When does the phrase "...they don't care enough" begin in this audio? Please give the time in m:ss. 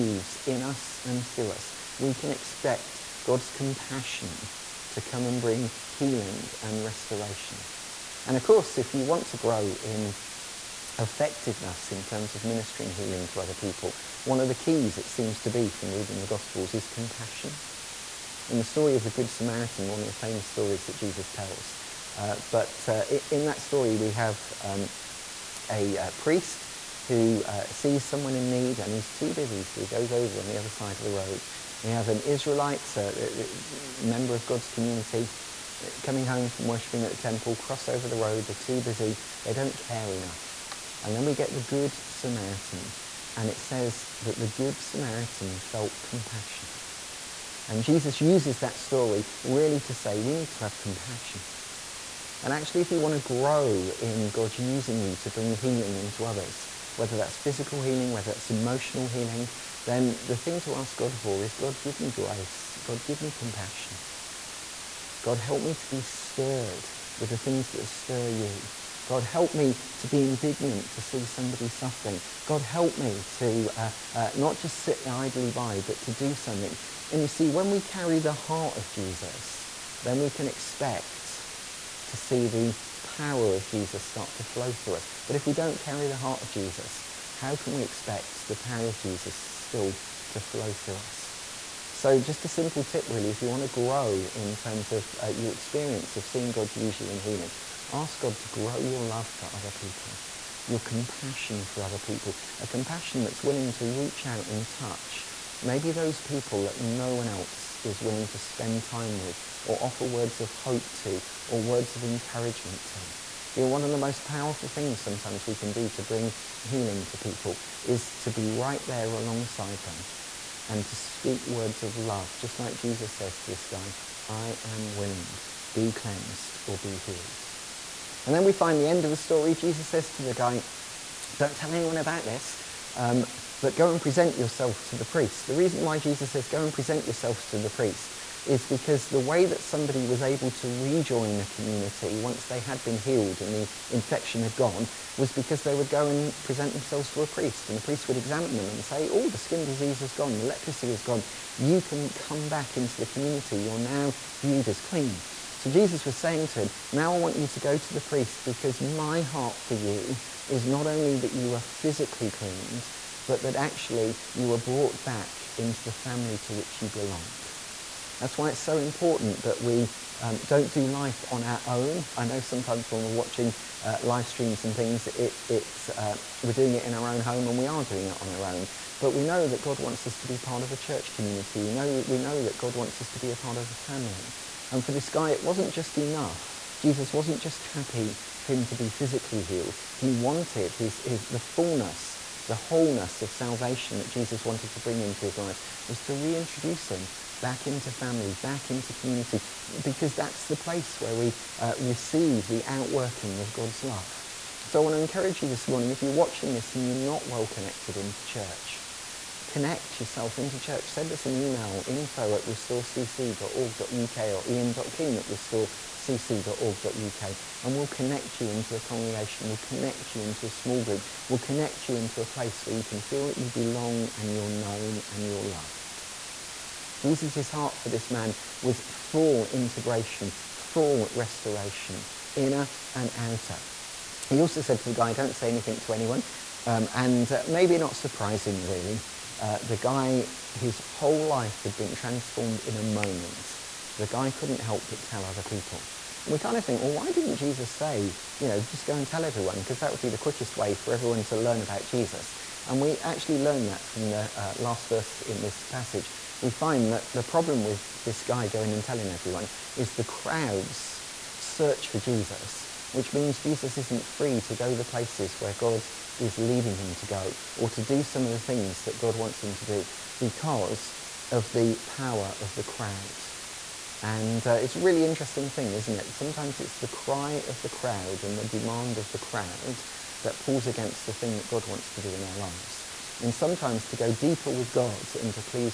0:39.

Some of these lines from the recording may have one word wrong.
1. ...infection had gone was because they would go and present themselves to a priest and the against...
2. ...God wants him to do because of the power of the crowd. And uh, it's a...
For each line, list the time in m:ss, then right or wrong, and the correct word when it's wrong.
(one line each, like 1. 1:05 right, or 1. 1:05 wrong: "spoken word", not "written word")
1. 2:23 wrong: "priest", not "against"
2. 4:28 right.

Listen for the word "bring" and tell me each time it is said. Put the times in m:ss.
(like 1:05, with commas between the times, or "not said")
0:05, 0:55, 1:56, 3:14.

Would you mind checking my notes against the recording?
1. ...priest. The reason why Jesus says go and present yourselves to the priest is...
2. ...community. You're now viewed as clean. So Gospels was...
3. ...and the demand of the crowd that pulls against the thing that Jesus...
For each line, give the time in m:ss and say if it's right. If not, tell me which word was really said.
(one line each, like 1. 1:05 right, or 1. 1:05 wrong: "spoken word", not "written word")
1. 2:15 right
2. 2:33 wrong: "Jesus", not "Gospels"
3. 4:38 wrong: "God", not "Jesus".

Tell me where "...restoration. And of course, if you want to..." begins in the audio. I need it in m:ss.
0:06.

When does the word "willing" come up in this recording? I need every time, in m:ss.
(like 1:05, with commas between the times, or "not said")
1:43, 1:48, 2:04.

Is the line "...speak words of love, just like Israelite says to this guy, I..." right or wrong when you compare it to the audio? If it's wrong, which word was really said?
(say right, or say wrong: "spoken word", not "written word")
wrong: "Jesus", not "Israelite".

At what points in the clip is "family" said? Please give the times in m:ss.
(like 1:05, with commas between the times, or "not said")
2:45, 3:03, 3:17.